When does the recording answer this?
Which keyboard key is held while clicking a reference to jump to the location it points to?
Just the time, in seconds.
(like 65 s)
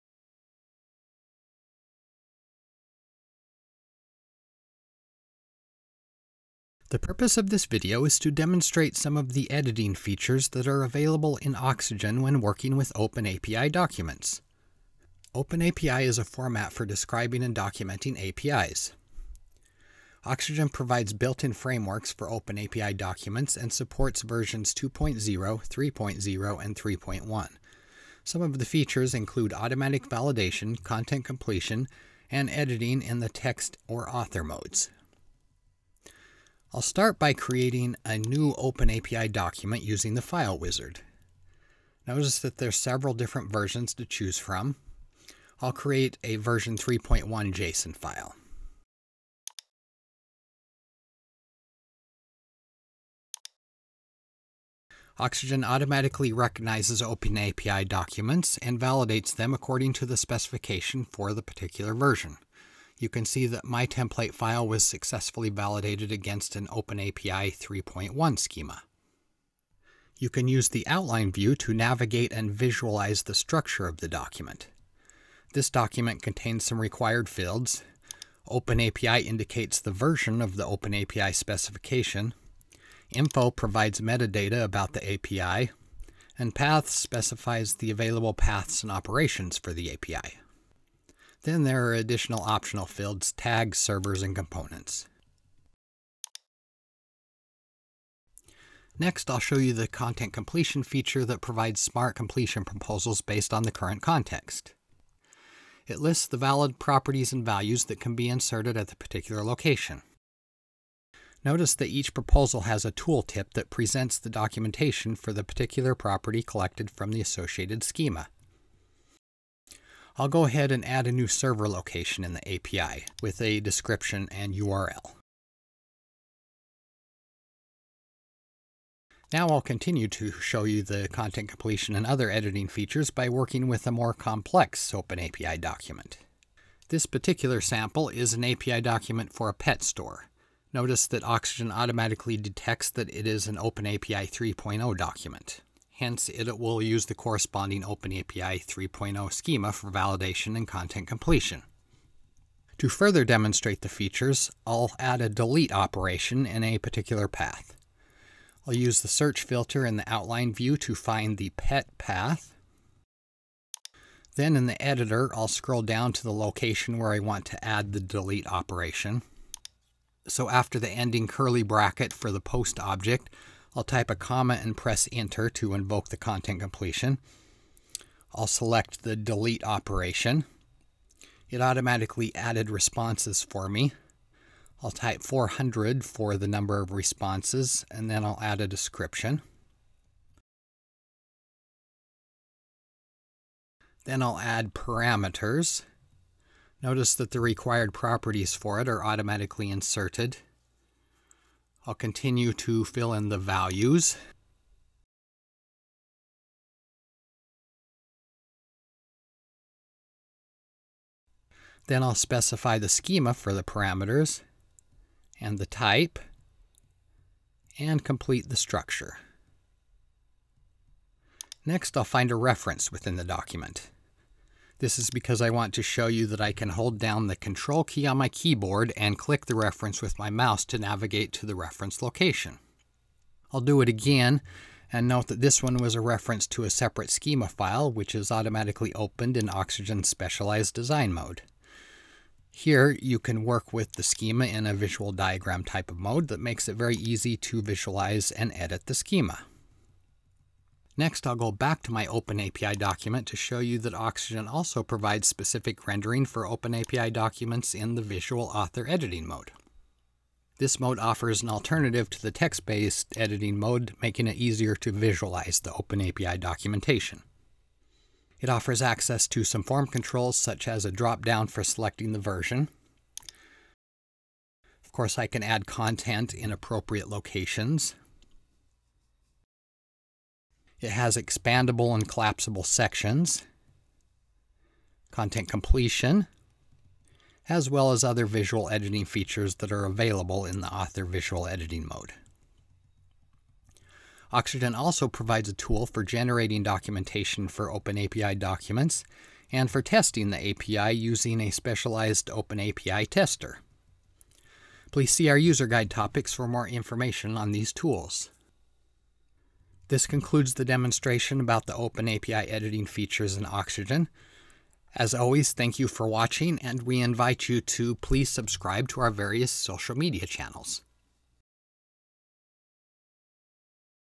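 227 s.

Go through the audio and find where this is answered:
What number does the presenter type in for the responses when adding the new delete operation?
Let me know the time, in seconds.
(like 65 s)
185 s.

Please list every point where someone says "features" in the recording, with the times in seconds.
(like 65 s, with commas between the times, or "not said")
9 s, 28 s, 100 s, 132 s, 153 s, 289 s, 312 s.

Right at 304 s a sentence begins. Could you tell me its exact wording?
Please see our user guide topics for more information on these tools.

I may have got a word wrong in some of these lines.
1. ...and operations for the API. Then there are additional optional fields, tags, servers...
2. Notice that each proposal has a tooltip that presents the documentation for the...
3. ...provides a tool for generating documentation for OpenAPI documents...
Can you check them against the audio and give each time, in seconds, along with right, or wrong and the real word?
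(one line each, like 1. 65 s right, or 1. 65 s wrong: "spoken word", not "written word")
1. 88 s right
2. 111 s right
3. 295 s right.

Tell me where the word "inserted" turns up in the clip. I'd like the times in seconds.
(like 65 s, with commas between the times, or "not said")
108 s, 199 s.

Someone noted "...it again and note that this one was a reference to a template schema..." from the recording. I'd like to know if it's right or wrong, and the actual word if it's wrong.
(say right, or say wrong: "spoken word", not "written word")
wrong: "separate", not "template".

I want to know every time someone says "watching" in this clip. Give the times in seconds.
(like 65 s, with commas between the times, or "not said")
316 s.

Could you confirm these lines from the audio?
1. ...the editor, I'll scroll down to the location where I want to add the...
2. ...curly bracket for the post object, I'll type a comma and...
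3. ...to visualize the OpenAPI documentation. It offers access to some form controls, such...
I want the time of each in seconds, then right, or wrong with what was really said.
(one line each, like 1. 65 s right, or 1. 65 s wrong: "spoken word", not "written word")
1. 164 s right
2. 171 s right
3. 264 s right.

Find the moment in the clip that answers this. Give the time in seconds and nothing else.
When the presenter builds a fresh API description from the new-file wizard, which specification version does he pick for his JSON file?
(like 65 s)
46 s.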